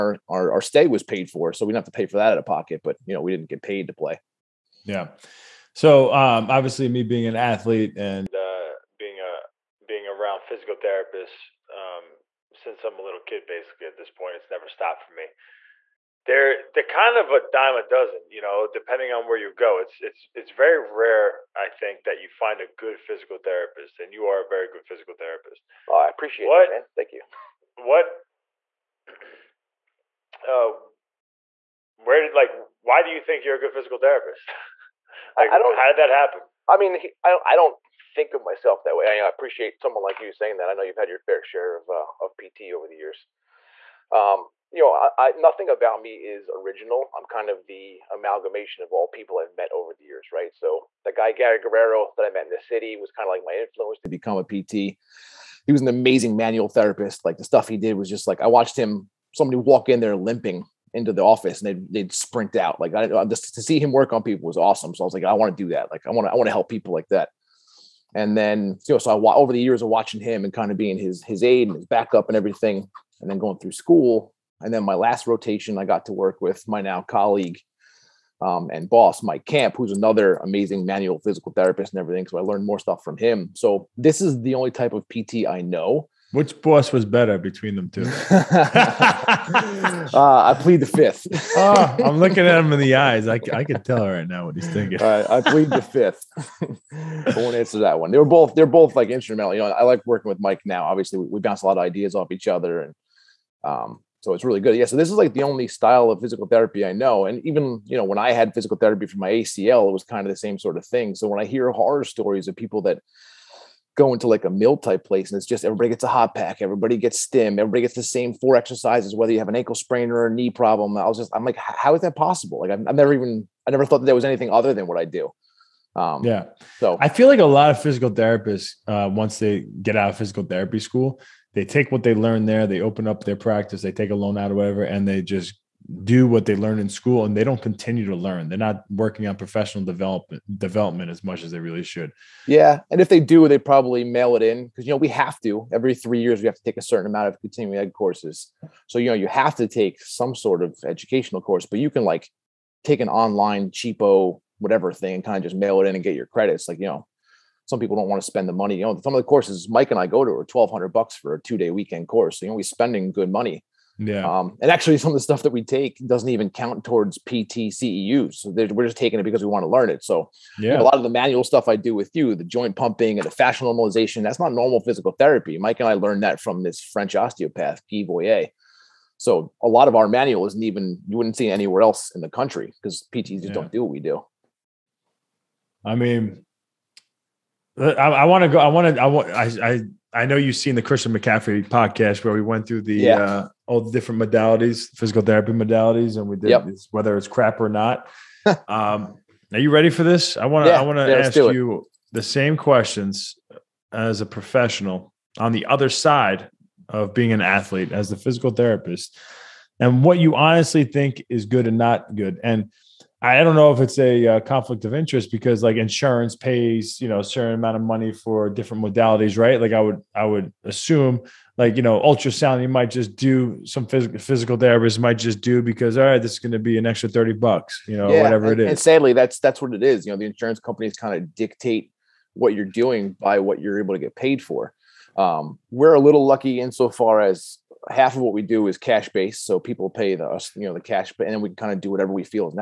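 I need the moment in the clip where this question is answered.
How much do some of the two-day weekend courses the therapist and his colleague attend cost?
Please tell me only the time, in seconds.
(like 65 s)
160 s.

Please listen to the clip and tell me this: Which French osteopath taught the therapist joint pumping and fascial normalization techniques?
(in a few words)
Guy Voyer.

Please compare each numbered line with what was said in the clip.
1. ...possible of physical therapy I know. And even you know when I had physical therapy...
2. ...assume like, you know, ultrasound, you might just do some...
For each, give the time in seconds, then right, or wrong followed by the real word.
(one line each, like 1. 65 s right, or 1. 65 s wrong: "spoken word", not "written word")
1. 105 s wrong: "style", not "possible"
2. 220 s right.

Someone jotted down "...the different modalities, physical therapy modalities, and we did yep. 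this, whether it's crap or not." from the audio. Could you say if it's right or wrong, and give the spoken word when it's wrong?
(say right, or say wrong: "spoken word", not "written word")
right.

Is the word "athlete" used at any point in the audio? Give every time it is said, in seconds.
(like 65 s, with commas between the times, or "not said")
7 s, 207 s.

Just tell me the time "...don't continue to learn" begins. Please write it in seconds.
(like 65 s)
137 s.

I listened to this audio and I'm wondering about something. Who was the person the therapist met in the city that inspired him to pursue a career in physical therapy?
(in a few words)
Gary Guerrero.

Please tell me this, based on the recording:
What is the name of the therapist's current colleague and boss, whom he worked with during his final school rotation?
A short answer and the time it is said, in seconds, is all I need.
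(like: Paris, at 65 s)
Mike Camp, at 79 s.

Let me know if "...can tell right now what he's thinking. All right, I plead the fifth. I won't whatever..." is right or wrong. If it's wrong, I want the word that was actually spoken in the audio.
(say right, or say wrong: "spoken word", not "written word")
wrong: "answer", not "whatever".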